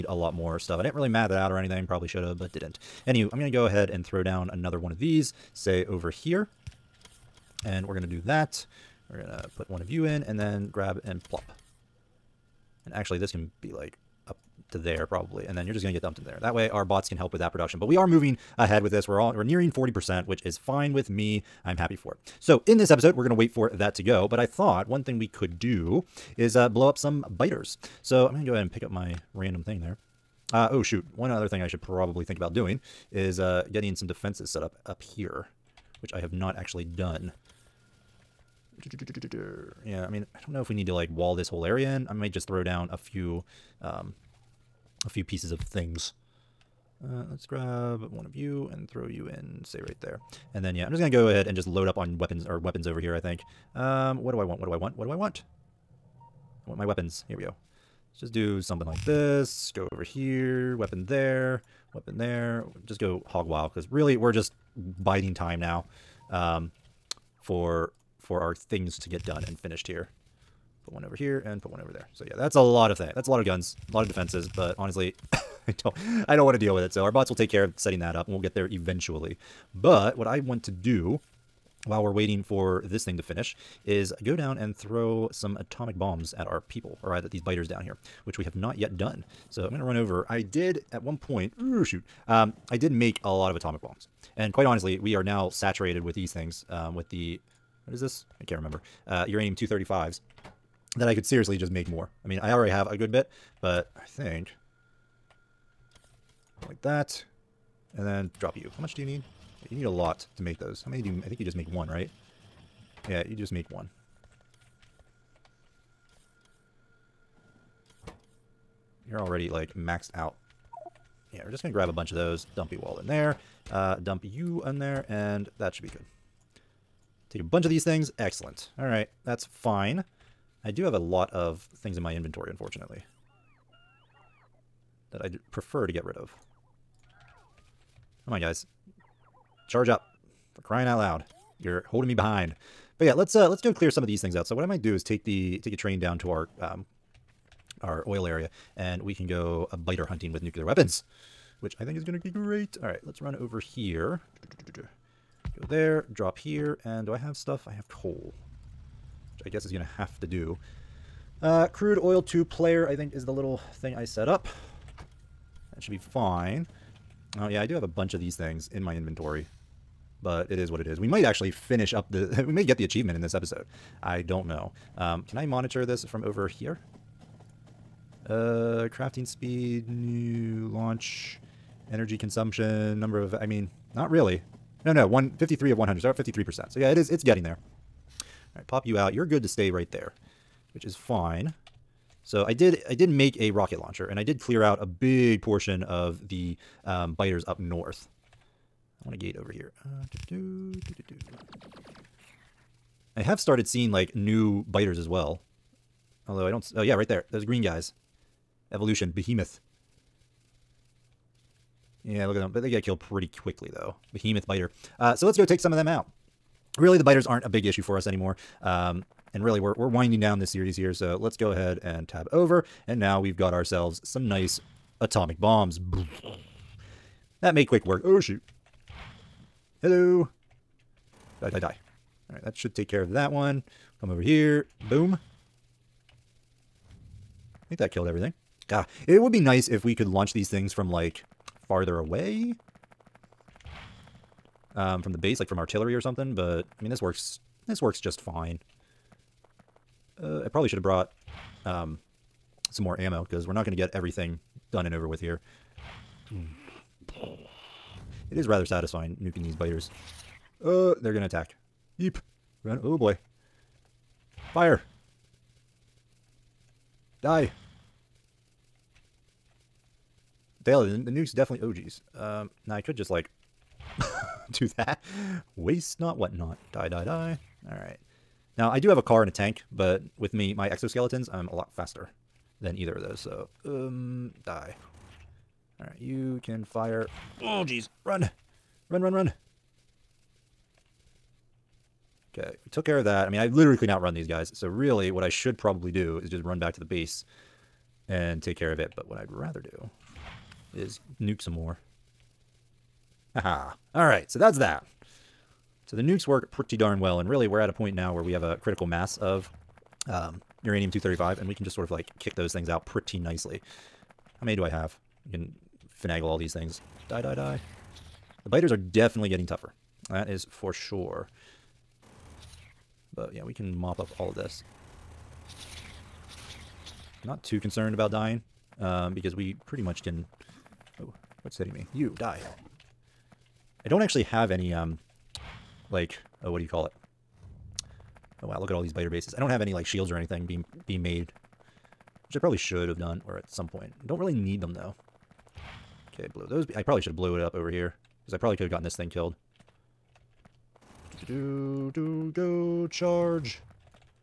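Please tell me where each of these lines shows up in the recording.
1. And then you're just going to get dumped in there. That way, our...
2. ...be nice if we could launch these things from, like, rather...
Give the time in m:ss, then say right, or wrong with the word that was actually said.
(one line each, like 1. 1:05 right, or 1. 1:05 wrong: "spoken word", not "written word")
1. 0:15 right
2. 3:59 wrong: "farther", not "rather".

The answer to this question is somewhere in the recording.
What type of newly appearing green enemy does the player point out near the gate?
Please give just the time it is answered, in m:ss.
3:34.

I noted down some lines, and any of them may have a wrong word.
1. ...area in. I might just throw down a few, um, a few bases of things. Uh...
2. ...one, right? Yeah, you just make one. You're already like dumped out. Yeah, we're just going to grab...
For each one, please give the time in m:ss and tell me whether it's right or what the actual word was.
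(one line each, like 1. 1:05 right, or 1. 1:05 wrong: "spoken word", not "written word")
1. 0:41 wrong: "pieces", not "bases"
2. 1:51 wrong: "maxed", not "dumped".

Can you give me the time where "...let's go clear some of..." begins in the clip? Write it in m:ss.
2:23.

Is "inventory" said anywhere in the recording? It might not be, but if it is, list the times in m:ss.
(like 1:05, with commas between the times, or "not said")
2:12, 2:48.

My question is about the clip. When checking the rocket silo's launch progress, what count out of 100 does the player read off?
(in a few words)
53.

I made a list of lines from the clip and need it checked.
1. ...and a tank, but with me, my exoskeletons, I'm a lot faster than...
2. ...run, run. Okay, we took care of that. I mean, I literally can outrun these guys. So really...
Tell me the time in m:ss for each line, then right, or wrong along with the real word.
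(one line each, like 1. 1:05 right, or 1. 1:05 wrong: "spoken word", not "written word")
1. 4:39 right
2. 4:49 right.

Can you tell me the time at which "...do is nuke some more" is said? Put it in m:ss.
4:59.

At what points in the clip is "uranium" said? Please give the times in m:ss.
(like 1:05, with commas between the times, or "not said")
1:39, 5:10.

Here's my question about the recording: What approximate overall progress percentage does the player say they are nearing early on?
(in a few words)
40%.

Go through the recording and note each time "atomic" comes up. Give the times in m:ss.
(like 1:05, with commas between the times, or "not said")
1:25, 1:33, 3:45.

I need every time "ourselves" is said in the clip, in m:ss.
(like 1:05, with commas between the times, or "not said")
3:43.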